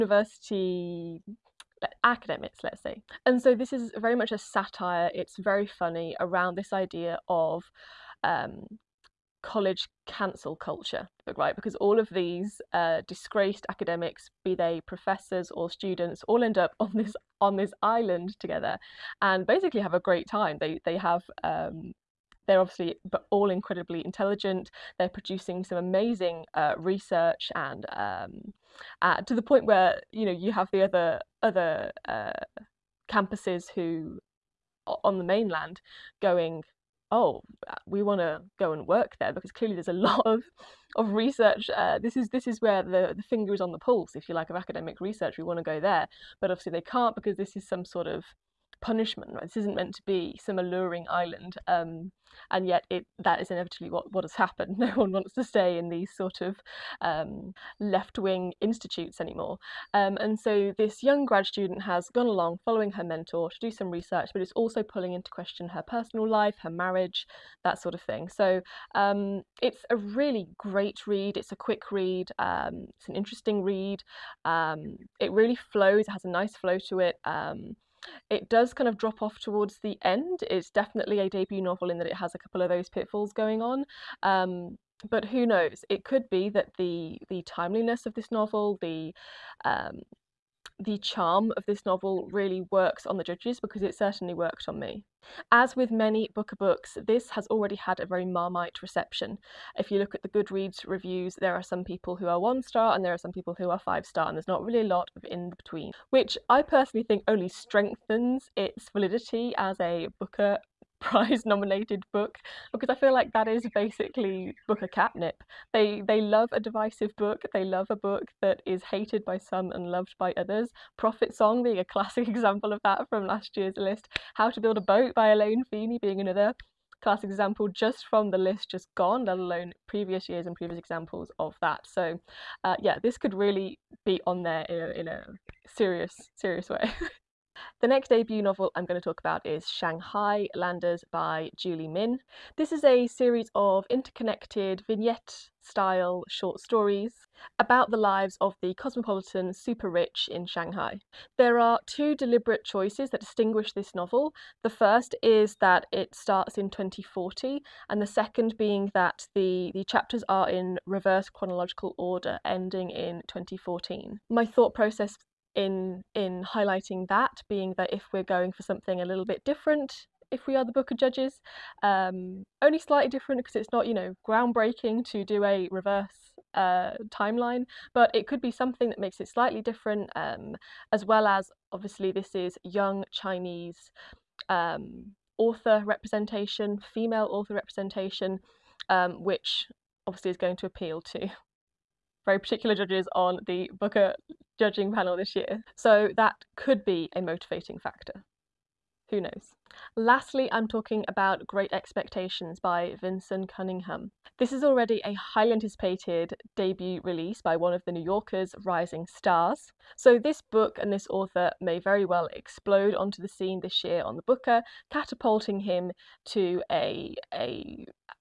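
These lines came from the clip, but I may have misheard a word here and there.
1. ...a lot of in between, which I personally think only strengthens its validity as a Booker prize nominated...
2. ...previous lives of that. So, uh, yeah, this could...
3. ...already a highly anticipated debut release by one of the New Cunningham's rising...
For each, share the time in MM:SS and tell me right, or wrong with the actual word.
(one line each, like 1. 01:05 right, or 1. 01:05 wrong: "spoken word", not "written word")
1. 01:44 right
2. 02:10 wrong: "examples", not "lives"
3. 03:24 wrong: "Yorker", not "Cunningham".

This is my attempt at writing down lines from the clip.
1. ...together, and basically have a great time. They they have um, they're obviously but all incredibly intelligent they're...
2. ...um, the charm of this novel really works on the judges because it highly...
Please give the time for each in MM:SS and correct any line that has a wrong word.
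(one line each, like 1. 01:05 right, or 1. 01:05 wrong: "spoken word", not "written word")
1. 00:18 right
2. 01:29 wrong: "certainly", not "highly".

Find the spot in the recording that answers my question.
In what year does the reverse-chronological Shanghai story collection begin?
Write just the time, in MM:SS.
02:36.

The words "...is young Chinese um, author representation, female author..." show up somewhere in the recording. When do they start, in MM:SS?
03:02.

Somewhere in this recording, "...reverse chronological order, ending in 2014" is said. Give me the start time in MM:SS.
02:40.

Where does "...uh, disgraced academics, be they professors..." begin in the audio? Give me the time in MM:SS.
00:12.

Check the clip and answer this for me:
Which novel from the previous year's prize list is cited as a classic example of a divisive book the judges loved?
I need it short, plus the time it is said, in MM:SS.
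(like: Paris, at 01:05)
Prophet Song, at 02:00.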